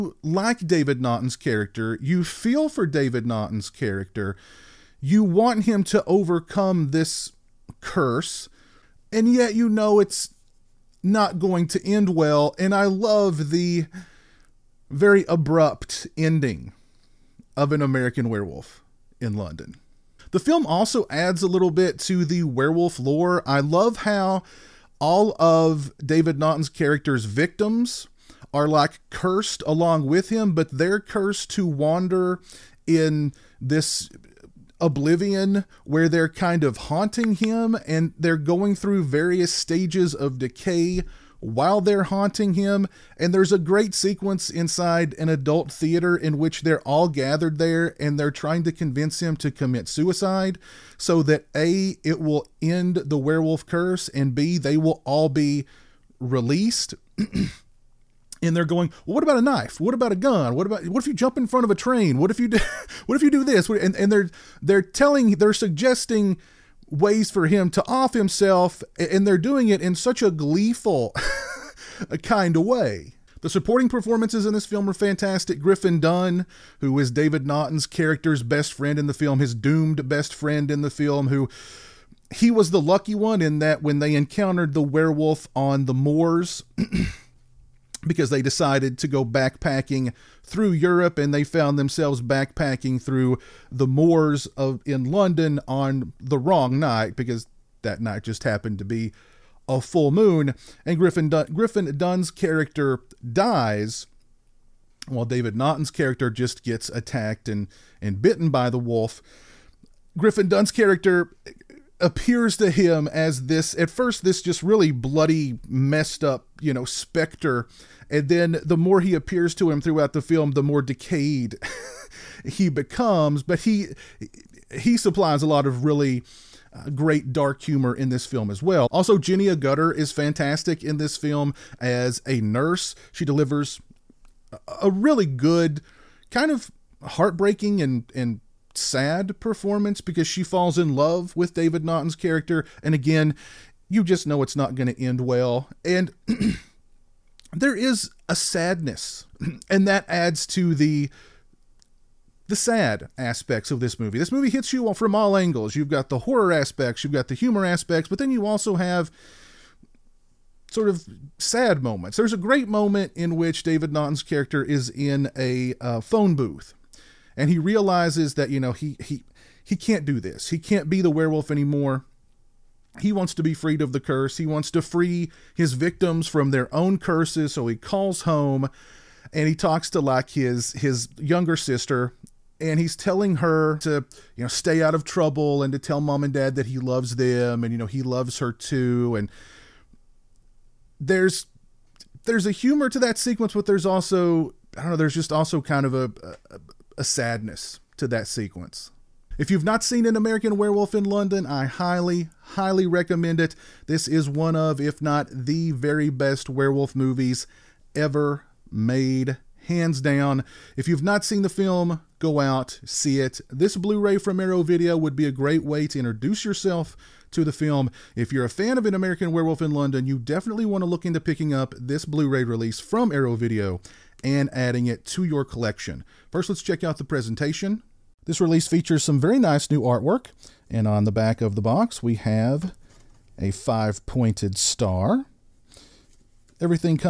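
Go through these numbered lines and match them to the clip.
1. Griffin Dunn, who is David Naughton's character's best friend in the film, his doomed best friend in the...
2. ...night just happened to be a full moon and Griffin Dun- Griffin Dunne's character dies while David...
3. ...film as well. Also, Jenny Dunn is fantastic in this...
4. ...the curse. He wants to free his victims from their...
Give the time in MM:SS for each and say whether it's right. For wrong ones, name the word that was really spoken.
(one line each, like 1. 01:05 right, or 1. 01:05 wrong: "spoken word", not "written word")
1. 01:15 right
2. 01:37 right
3. 02:08 wrong: "Agutter", not "Dunn"
4. 02:53 right.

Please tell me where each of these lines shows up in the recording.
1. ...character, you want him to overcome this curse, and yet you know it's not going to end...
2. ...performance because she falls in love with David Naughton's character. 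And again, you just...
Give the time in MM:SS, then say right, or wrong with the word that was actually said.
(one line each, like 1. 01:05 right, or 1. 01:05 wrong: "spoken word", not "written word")
1. 00:03 right
2. 02:19 right.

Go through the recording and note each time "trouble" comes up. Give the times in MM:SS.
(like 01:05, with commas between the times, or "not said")
03:05.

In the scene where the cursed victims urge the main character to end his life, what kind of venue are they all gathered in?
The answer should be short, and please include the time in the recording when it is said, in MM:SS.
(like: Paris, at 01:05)
adult theater, at 00:45.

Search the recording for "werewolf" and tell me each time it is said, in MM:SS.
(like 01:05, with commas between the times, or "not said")
00:18, 00:22, 00:53, 01:24, 02:51, 03:20, 03:26, 03:39.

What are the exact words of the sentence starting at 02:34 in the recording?
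This movie hits you from all angles.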